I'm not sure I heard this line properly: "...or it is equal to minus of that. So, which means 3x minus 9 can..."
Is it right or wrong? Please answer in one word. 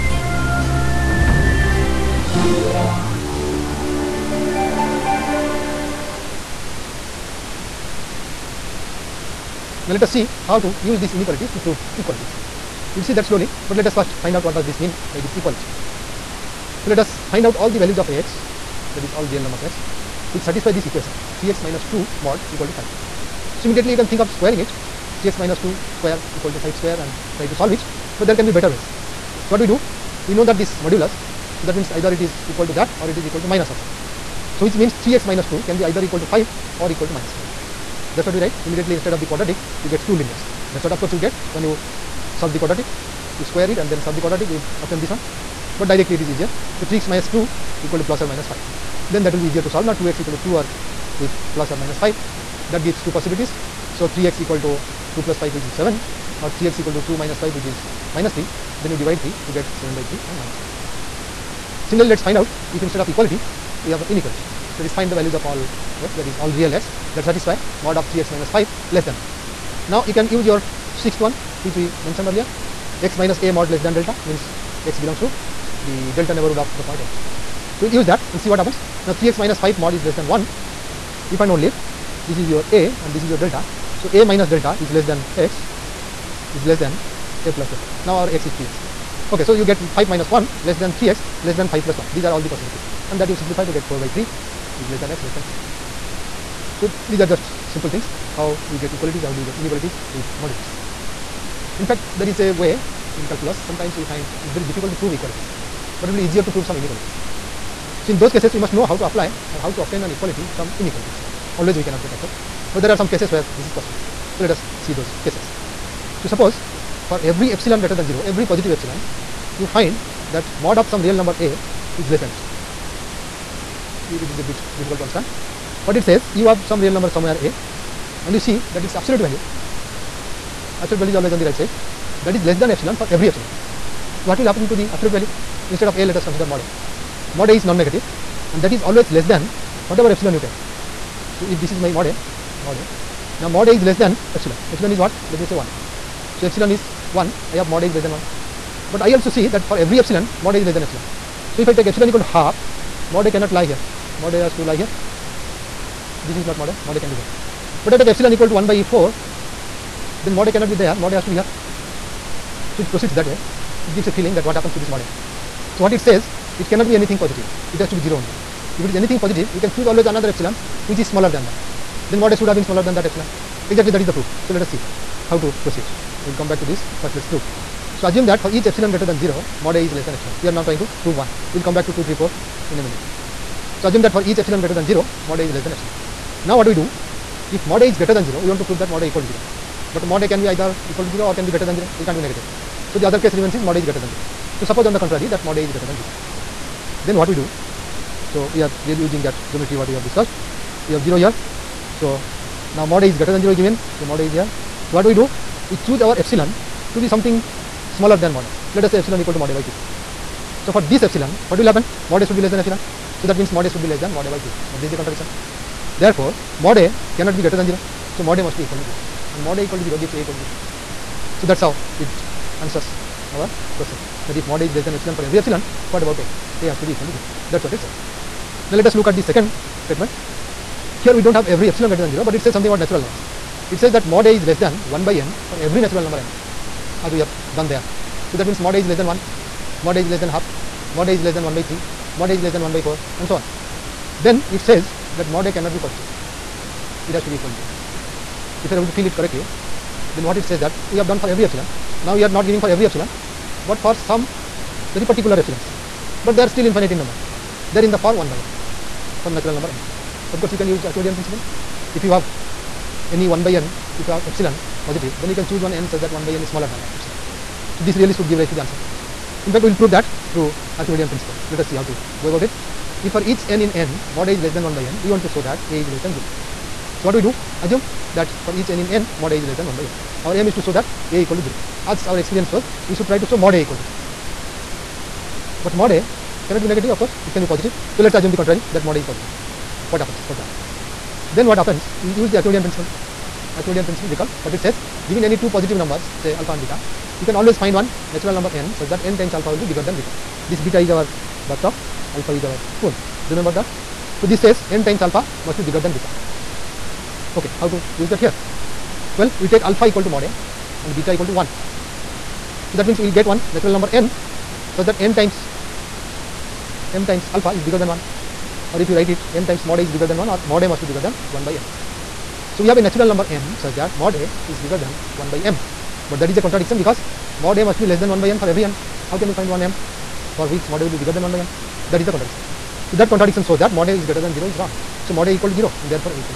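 wrong.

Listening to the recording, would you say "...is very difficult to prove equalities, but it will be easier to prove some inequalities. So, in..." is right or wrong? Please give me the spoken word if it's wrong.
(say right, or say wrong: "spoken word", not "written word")
right.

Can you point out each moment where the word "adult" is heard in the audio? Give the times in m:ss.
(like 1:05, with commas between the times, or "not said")
not said.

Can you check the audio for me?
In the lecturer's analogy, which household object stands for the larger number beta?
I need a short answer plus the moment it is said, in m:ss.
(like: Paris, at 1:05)
bathtub, at 5:01.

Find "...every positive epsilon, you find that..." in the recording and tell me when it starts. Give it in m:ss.
1:58.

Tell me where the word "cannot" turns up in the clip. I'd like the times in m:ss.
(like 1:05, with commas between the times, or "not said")
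1:51, 2:33, 2:40, 2:46, 3:37, 4:05, 4:46.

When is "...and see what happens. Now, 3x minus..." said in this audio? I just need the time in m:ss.
1:18.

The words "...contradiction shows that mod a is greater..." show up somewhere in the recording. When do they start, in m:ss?
5:33.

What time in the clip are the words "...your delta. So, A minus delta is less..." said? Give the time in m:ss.
1:23.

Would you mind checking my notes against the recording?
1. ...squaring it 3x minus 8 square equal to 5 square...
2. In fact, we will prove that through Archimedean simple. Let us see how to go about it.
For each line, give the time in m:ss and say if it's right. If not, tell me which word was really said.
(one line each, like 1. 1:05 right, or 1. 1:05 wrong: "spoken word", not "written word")
1. 0:24 wrong: "2", not "8"
2. 4:29 wrong: "principle", not "simple".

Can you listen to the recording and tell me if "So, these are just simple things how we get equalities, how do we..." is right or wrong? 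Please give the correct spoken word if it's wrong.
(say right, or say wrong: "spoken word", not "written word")
right.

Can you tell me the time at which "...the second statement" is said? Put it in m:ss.
3:49.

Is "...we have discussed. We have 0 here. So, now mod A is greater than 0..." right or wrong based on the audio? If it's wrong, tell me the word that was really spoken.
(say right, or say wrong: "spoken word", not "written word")
right.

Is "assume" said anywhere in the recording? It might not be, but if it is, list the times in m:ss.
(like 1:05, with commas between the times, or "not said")
2:58, 3:03, 4:37, 4:48.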